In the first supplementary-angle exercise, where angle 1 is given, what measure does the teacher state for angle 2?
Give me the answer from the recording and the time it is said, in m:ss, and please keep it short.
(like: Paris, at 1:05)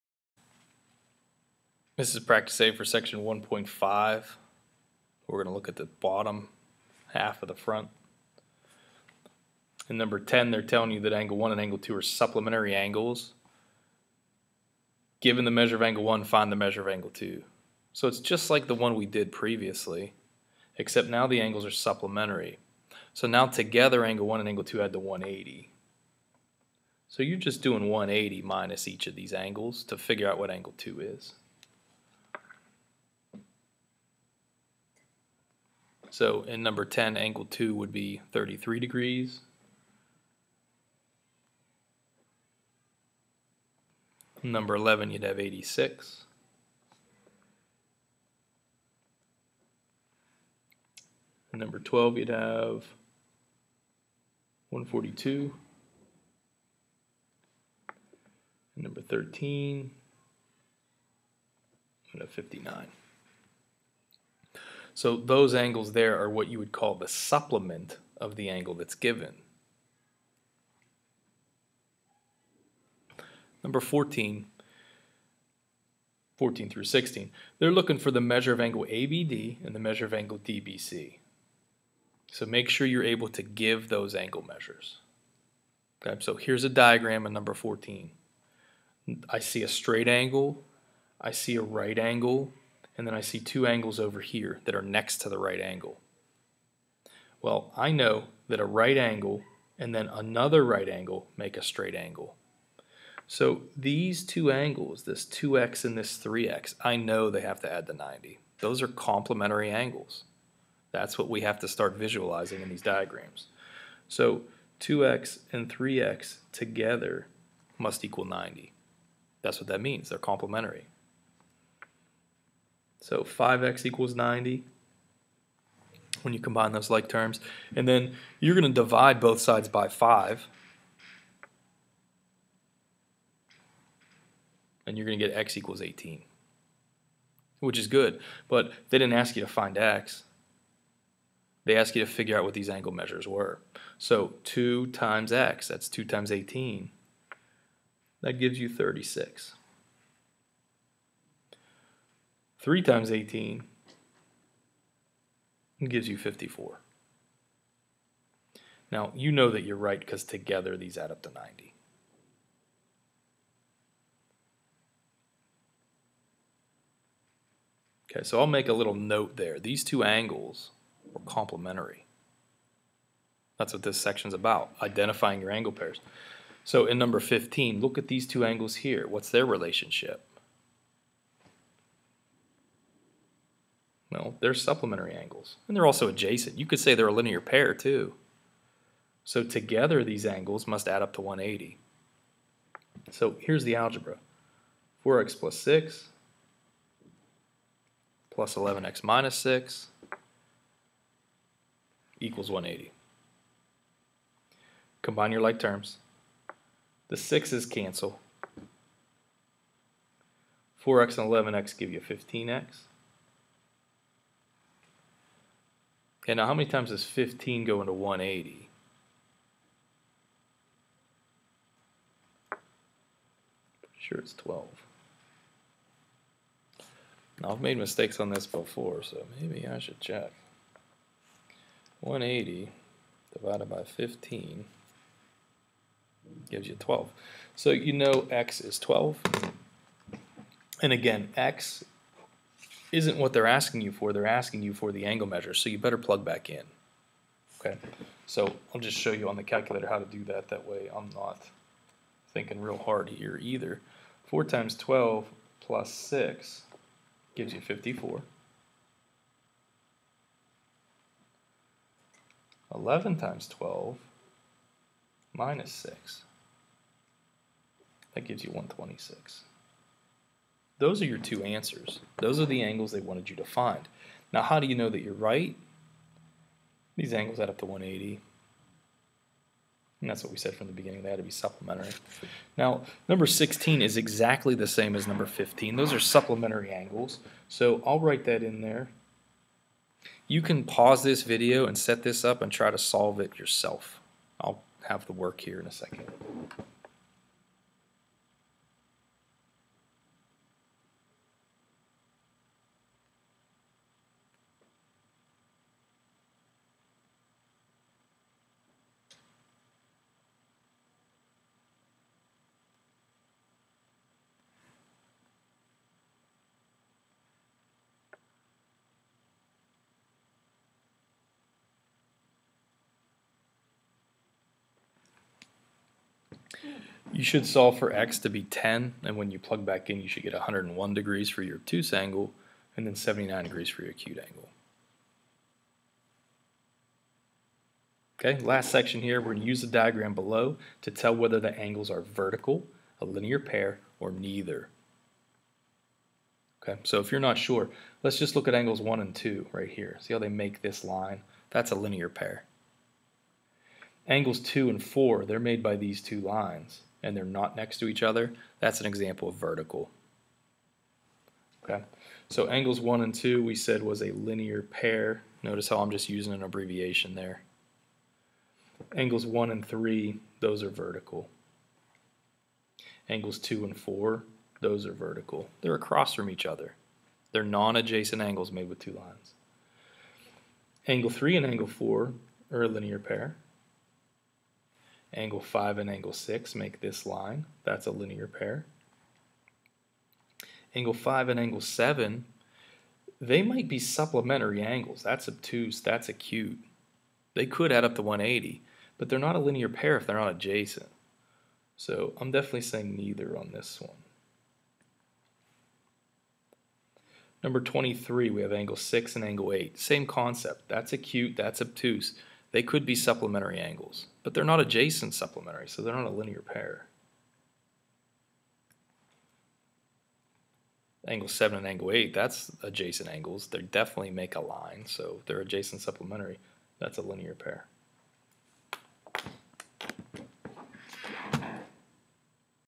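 33 degrees, at 0:38.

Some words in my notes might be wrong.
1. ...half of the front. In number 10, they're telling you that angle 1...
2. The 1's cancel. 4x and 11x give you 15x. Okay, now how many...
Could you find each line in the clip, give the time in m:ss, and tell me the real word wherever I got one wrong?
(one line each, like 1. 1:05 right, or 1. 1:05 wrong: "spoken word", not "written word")
1. 0:07 right
2. 3:27 wrong: "6", not "1".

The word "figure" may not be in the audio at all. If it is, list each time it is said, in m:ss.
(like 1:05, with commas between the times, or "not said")
0:29, 2:22.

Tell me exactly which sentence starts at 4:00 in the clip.
And again, x isn't what they're asking you for.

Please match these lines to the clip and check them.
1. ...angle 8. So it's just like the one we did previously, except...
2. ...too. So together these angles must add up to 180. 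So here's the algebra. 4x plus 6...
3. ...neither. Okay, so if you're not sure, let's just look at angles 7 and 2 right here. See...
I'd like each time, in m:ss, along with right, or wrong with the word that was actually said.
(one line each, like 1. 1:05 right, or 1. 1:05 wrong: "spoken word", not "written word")
1. 0:16 wrong: "2", not "8"
2. 3:07 right
3. 5:44 wrong: "1", not "7".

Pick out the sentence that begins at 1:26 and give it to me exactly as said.
Okay, so here's a diagram of number 14.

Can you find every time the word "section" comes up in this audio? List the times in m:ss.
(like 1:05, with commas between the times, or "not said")
0:02, 2:53, 5:38.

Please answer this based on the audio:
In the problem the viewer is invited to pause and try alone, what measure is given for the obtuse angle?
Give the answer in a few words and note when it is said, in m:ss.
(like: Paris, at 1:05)
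101 degrees, at 5:30.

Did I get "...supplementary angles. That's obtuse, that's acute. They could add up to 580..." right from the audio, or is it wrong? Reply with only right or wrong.
wrong.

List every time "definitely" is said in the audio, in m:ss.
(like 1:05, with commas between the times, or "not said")
6:42, 7:03.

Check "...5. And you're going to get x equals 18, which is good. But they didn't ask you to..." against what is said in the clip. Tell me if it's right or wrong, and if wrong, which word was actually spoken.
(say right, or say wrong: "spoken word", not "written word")
right.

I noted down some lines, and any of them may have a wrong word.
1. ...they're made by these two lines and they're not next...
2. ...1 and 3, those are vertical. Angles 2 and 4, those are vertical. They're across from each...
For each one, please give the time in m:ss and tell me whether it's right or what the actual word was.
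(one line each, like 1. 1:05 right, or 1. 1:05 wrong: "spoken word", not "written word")
1. 5:55 right
2. 6:09 right.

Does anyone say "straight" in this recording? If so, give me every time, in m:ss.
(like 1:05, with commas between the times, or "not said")
1:29, 1:41.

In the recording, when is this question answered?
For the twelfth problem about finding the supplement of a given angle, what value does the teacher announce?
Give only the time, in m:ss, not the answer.
0:54.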